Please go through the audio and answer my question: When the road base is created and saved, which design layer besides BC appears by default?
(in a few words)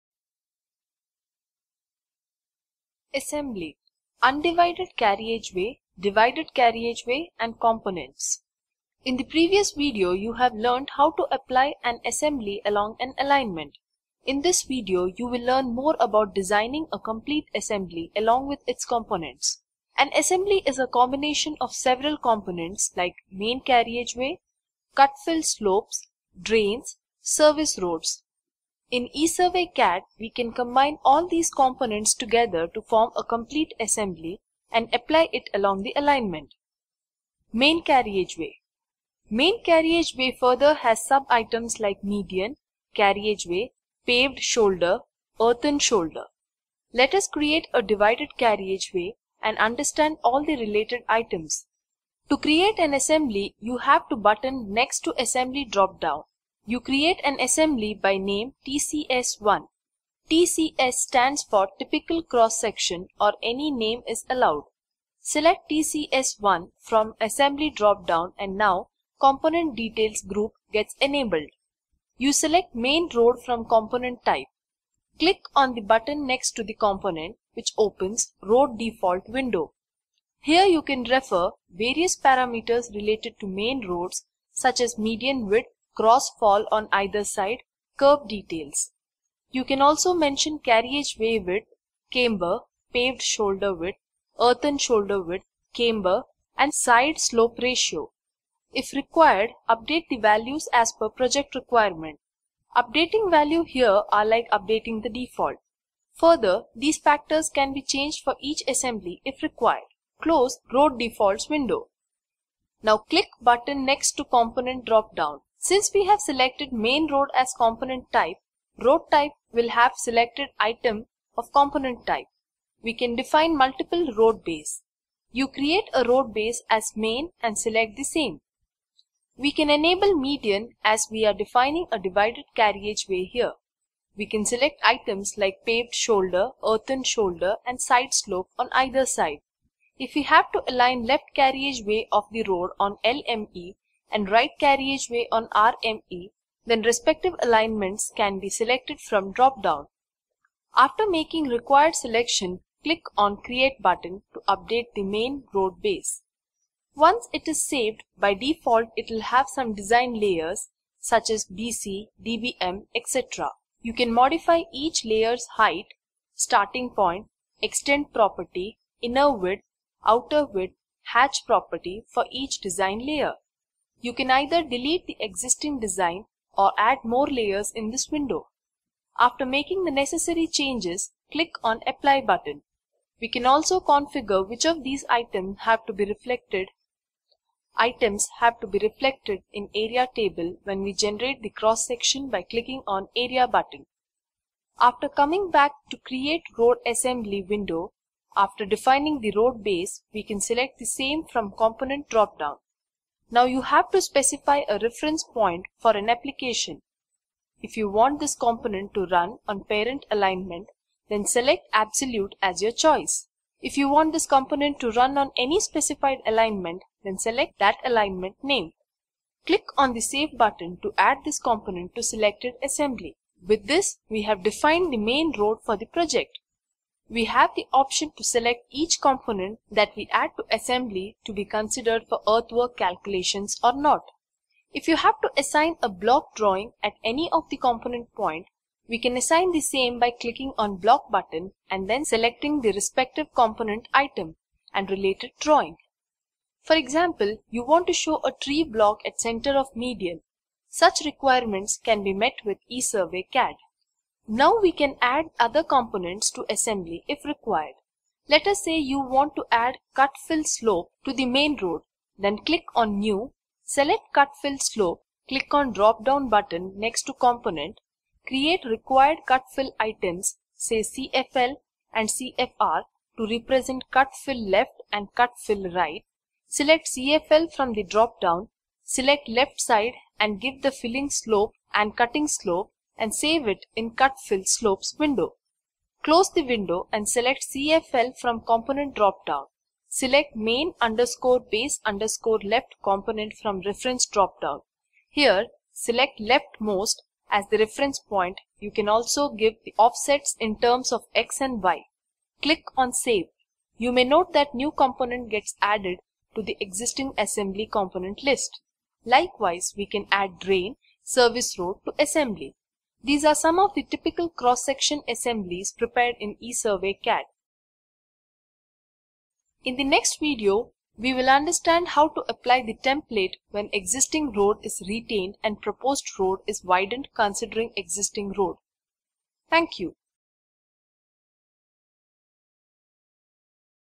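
DBM.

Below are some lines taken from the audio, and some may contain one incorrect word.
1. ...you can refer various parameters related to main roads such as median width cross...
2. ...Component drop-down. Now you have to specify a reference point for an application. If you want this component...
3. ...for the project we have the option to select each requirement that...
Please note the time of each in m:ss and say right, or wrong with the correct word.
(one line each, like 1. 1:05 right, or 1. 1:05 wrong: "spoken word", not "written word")
1. 1:20 right
2. 3:21 right
3. 3:45 wrong: "component", not "requirement".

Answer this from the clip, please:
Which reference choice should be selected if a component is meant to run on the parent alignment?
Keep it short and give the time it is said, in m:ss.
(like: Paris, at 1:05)
absolute, at 3:31.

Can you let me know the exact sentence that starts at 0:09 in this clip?
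In the previous video you have learned how to apply an assembly along an alignment.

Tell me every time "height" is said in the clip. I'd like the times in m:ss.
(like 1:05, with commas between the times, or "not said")
2:45.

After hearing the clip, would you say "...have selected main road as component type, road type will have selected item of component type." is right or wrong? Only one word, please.
right.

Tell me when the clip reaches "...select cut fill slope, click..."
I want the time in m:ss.
4:23.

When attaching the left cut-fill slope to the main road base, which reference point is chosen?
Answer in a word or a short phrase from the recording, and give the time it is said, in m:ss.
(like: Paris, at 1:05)
leftmost, at 4:56.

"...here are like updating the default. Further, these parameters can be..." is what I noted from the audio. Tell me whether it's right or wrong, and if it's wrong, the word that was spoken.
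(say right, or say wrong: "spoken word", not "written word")
wrong: "factors", not "parameters".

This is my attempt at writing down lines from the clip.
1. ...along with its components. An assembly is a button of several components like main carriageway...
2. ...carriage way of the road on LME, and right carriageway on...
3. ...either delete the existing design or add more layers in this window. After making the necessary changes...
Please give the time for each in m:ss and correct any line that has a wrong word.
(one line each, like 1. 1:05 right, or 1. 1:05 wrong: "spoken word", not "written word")
1. 0:18 wrong: "combination", not "button"
2. 2:21 right
3. 2:54 right.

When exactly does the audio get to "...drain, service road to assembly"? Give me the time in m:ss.
5:10.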